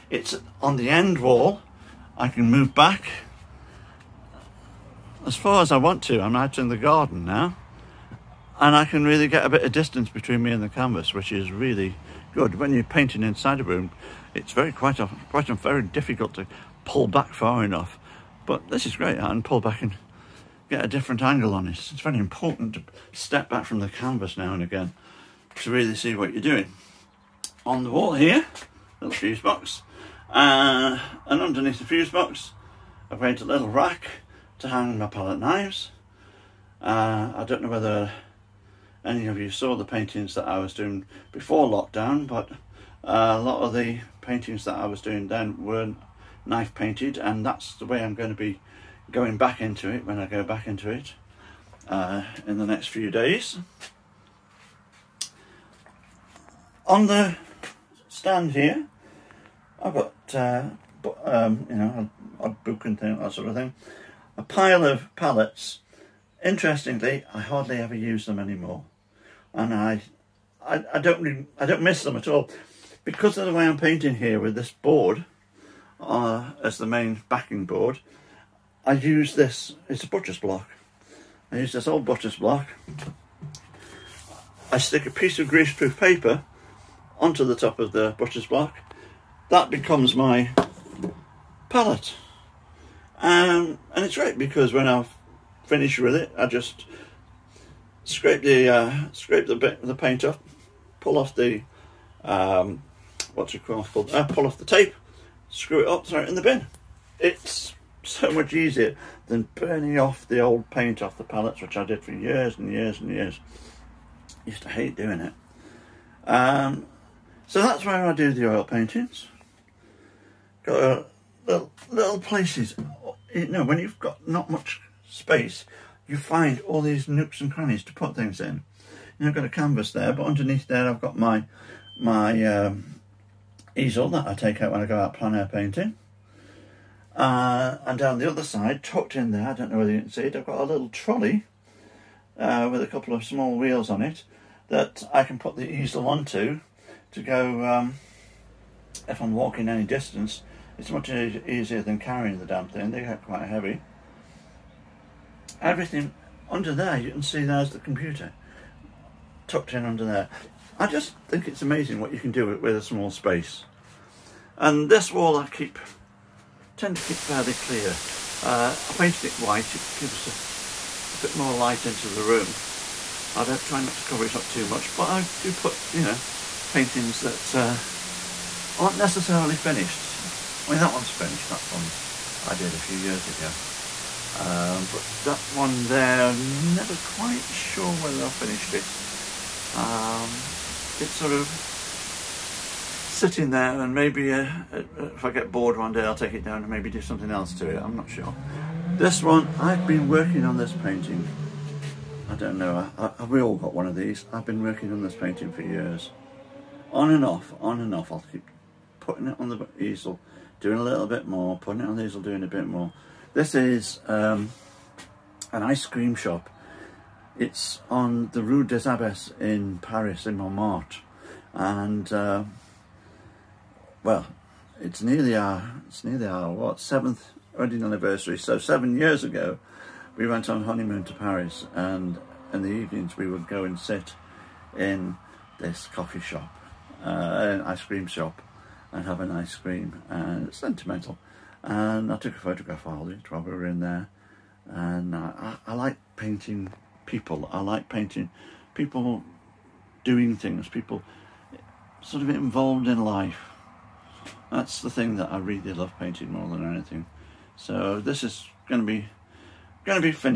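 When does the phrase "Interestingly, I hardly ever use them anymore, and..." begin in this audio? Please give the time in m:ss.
1:06.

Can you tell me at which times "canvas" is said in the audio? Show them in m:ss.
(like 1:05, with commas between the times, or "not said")
0:10, 0:23, 2:09.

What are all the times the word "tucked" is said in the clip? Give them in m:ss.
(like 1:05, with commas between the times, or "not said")
2:18, 2:39.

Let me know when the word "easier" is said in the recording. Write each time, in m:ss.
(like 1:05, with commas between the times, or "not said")
1:48, 2:31.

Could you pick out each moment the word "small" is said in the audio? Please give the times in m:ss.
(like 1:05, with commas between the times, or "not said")
2:23, 2:42.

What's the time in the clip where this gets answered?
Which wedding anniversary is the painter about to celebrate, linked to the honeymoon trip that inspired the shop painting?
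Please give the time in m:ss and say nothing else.
3:46.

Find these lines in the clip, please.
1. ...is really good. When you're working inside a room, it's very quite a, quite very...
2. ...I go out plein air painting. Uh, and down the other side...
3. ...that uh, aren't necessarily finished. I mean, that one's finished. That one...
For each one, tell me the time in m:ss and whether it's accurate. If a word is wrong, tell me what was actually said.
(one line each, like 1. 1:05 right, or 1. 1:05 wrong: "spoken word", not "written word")
1. 0:11 wrong: "painting", not "working"
2. 2:14 right
3. 2:57 right.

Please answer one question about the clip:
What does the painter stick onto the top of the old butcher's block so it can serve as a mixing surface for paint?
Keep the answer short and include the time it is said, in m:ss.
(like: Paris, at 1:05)
greaseproof paper, at 1:25.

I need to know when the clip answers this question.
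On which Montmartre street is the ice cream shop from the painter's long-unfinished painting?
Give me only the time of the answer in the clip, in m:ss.
3:38.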